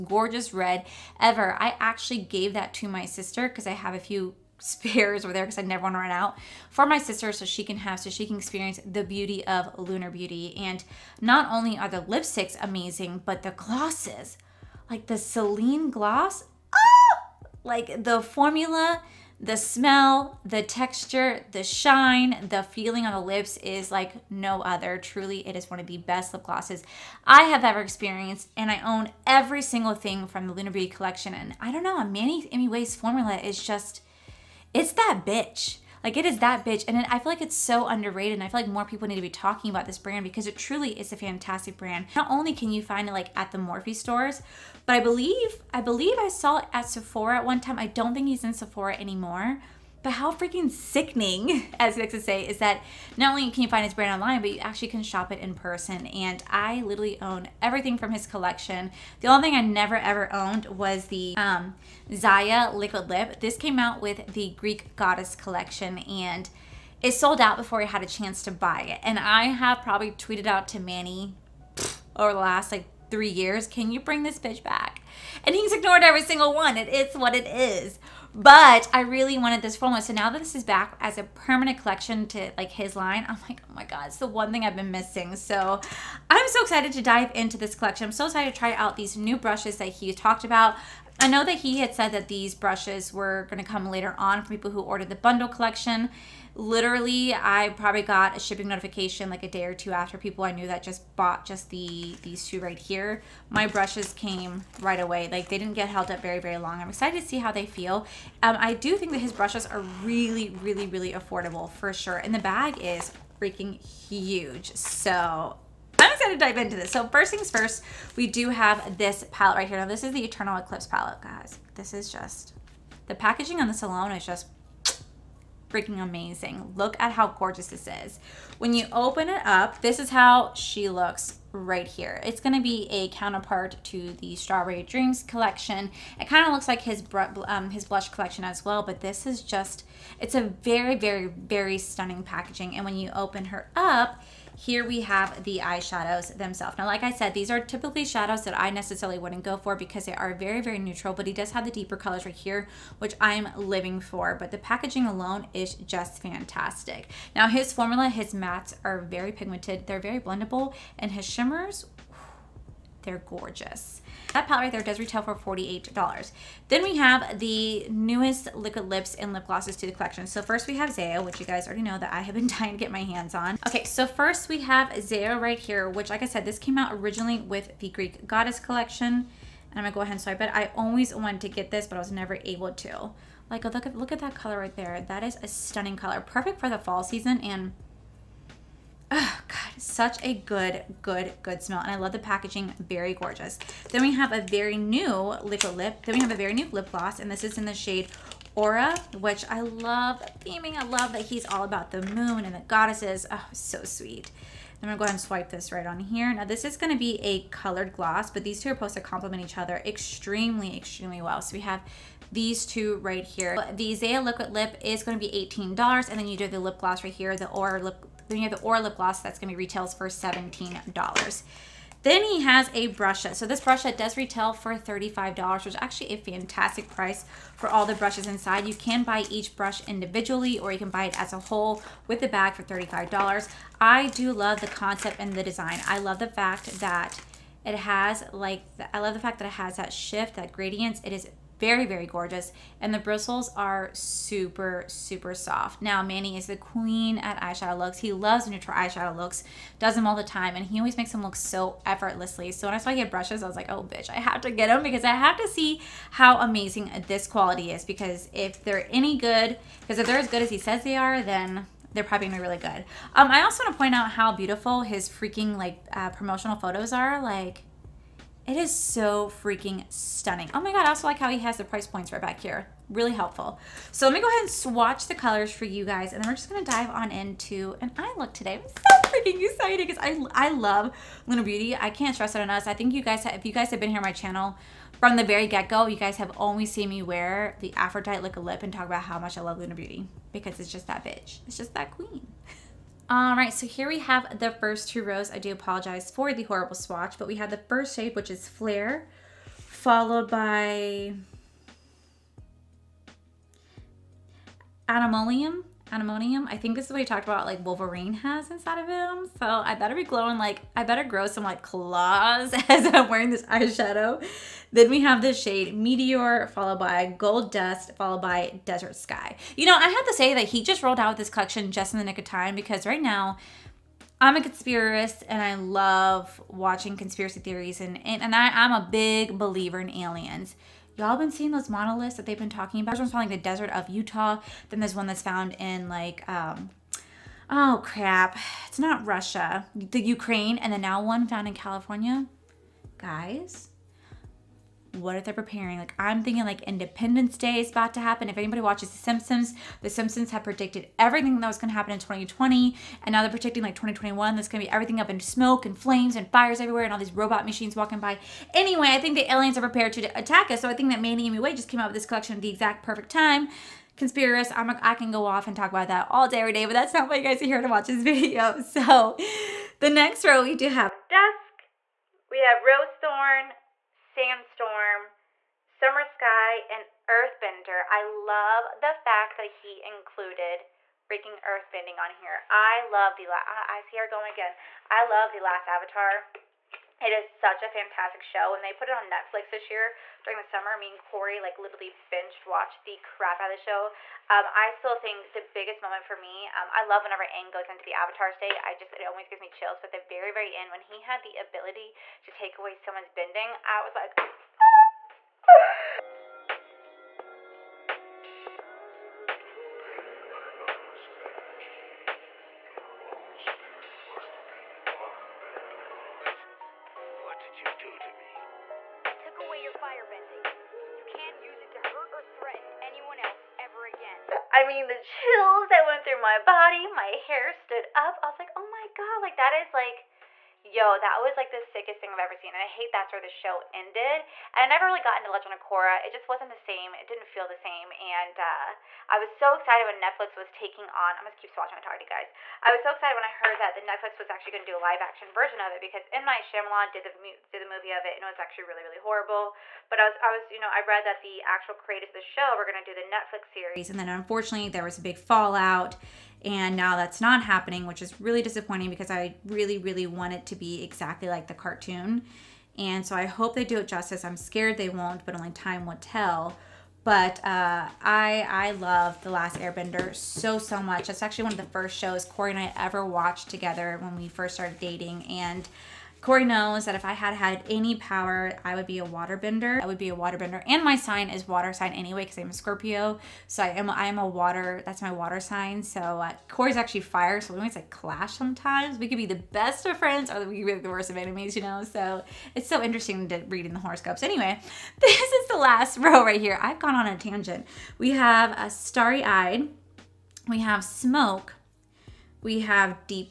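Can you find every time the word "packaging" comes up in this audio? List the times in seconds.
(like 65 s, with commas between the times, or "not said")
123 s, 142 s, 154 s, 192 s.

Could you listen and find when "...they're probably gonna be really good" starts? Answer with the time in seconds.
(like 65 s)
261 s.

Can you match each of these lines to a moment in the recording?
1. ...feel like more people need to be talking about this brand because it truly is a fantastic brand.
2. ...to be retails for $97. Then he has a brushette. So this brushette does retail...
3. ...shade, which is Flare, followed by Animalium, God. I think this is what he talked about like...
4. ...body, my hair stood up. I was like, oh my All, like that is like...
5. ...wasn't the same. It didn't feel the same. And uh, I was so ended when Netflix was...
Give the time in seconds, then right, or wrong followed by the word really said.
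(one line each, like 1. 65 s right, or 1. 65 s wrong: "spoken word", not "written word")
1. 38 s right
2. 219 s wrong: "17", not "97"
3. 297 s wrong: "Animonium", not "God"
4. 426 s wrong: "God", not "All"
5. 436 s wrong: "excited", not "ended".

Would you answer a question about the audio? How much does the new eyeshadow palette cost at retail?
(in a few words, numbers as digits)
$48.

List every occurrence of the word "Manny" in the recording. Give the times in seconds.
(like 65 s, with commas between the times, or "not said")
32 s, 70 s, 246 s, 361 s.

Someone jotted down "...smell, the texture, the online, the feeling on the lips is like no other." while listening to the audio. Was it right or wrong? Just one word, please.
wrong.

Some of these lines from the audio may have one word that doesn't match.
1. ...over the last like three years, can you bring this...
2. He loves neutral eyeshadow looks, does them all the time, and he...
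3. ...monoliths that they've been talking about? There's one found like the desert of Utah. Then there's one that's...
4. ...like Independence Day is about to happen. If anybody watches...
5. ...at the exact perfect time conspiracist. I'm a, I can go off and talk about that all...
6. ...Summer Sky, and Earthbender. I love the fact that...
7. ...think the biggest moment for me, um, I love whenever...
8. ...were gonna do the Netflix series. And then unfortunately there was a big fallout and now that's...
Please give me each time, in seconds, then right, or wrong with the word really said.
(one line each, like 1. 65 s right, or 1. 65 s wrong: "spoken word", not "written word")
1. 72 s right
2. 247 s right
3. 331 s right
4. 346 s right
5. 362 s right
6. 375 s right
7. 394 s right
8. 452 s right.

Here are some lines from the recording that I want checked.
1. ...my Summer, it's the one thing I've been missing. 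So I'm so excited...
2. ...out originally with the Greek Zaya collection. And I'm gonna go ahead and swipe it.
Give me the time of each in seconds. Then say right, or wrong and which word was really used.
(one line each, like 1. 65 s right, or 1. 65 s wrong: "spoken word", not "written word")
1. 83 s wrong: "God", not "Summer"
2. 176 s wrong: "Goddess", not "Zaya".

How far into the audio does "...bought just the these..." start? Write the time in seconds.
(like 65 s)
101 s.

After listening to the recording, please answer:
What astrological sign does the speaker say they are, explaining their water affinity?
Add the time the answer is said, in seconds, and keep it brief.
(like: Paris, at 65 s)
Scorpio, at 482 s.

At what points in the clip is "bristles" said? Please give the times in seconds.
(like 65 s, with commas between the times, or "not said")
242 s.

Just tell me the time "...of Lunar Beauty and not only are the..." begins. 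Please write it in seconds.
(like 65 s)
9 s.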